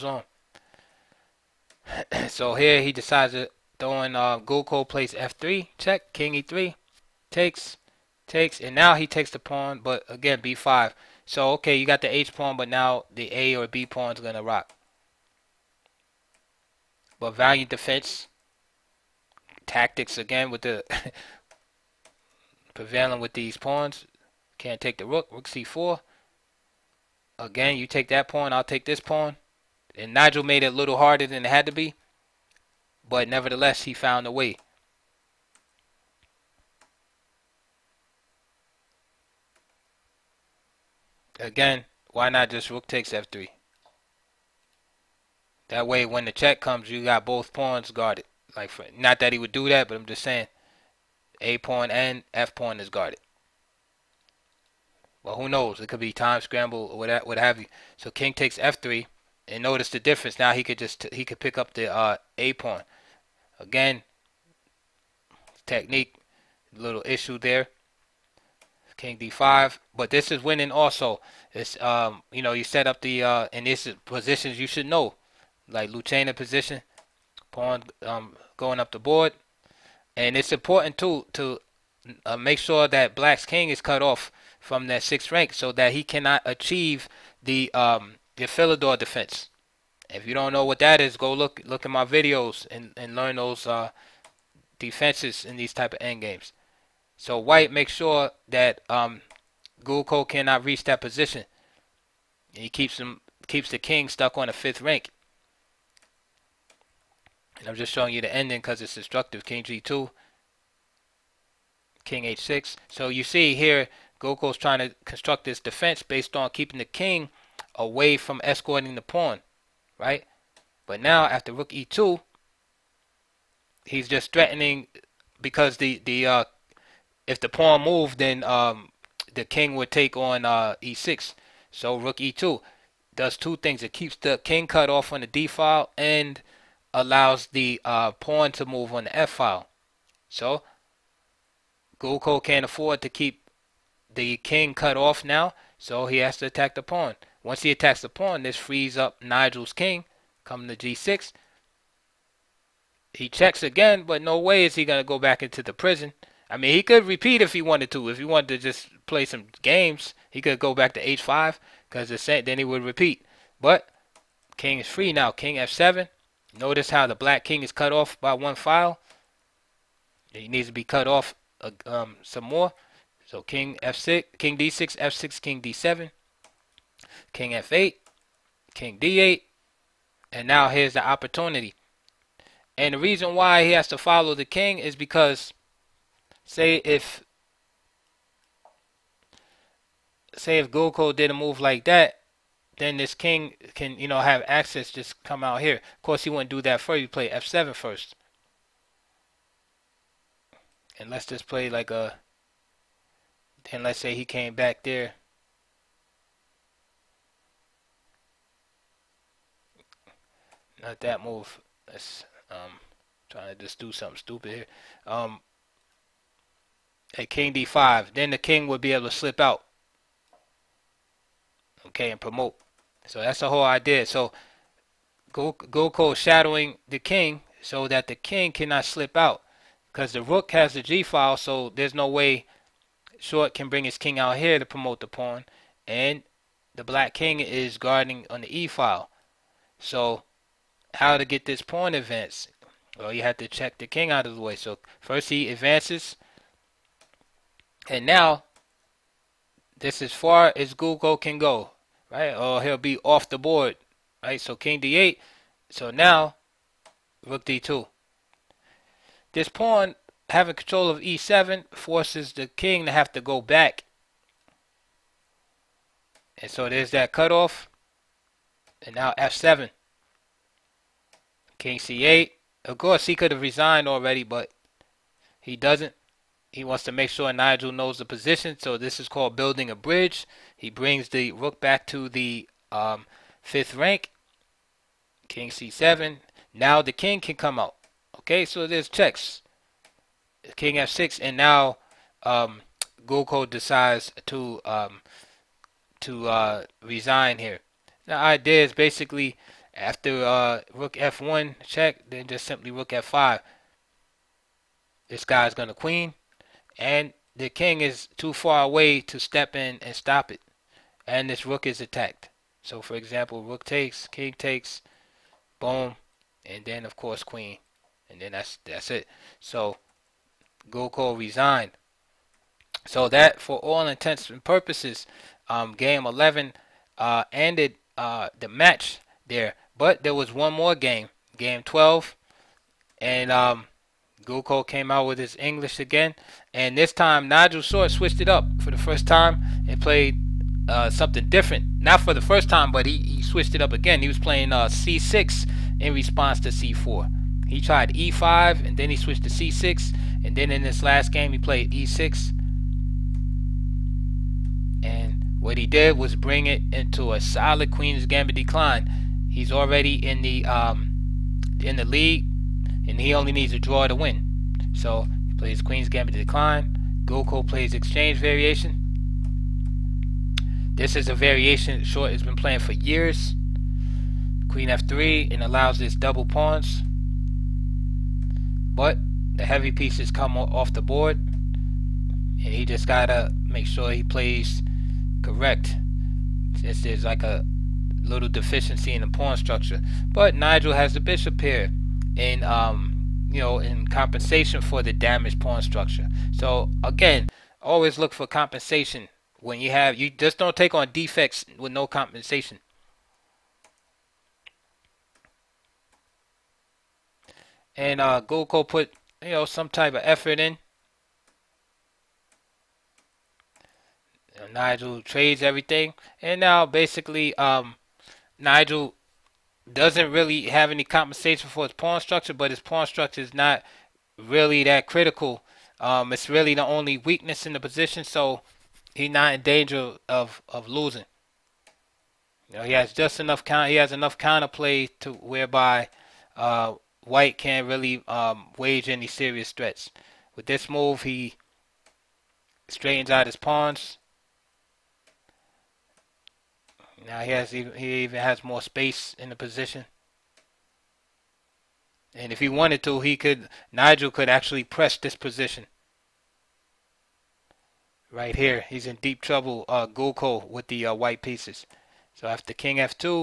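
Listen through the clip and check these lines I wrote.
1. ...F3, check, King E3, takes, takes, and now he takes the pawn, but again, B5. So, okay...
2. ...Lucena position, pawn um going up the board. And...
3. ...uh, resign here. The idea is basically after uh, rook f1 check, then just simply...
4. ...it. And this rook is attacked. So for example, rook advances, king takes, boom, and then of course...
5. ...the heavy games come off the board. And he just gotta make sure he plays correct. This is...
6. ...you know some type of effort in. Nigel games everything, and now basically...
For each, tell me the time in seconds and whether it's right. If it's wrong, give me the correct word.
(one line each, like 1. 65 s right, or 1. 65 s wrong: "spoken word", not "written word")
1. 5 s right
2. 75 s right
3. 296 s right
4. 310 s wrong: "takes", not "advances"
5. 379 s wrong: "pieces", not "games"
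6. 409 s wrong: "trades", not "games".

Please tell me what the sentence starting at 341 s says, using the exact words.
Not for the first time, but he, he switched it up again.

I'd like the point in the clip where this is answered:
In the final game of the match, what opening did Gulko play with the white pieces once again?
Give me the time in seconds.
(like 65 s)
335 s.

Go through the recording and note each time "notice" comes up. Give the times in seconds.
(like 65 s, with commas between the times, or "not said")
59 s, 166 s.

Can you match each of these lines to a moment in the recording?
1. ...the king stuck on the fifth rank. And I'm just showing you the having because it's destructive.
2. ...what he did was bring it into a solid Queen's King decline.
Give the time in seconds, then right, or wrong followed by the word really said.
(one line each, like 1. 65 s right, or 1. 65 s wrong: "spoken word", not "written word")
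1. 103 s wrong: "ending", not "having"
2. 355 s wrong: "Gambit", not "King".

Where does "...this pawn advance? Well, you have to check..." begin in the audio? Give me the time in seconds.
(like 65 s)
241 s.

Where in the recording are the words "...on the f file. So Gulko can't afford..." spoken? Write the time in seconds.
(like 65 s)
138 s.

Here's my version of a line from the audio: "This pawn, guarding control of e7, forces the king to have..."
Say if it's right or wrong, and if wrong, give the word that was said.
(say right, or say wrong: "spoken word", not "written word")
wrong: "having", not "guarding".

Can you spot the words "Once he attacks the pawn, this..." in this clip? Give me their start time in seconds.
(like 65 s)
147 s.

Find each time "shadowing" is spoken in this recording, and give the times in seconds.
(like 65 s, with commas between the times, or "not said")
226 s.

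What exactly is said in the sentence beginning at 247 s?
And now, this is far as Gulko can go right?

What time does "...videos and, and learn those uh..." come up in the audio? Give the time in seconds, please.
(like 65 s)
92 s.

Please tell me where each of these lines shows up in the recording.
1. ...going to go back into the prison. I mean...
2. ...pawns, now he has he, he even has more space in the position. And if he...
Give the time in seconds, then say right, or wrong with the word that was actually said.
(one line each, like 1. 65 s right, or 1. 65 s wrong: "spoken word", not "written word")
1. 154 s right
2. 443 s right.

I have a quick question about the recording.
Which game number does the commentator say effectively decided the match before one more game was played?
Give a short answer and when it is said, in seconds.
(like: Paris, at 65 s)
Game 11, at 325 s.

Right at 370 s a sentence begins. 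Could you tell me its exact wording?
This is a variation Short has been playing for years.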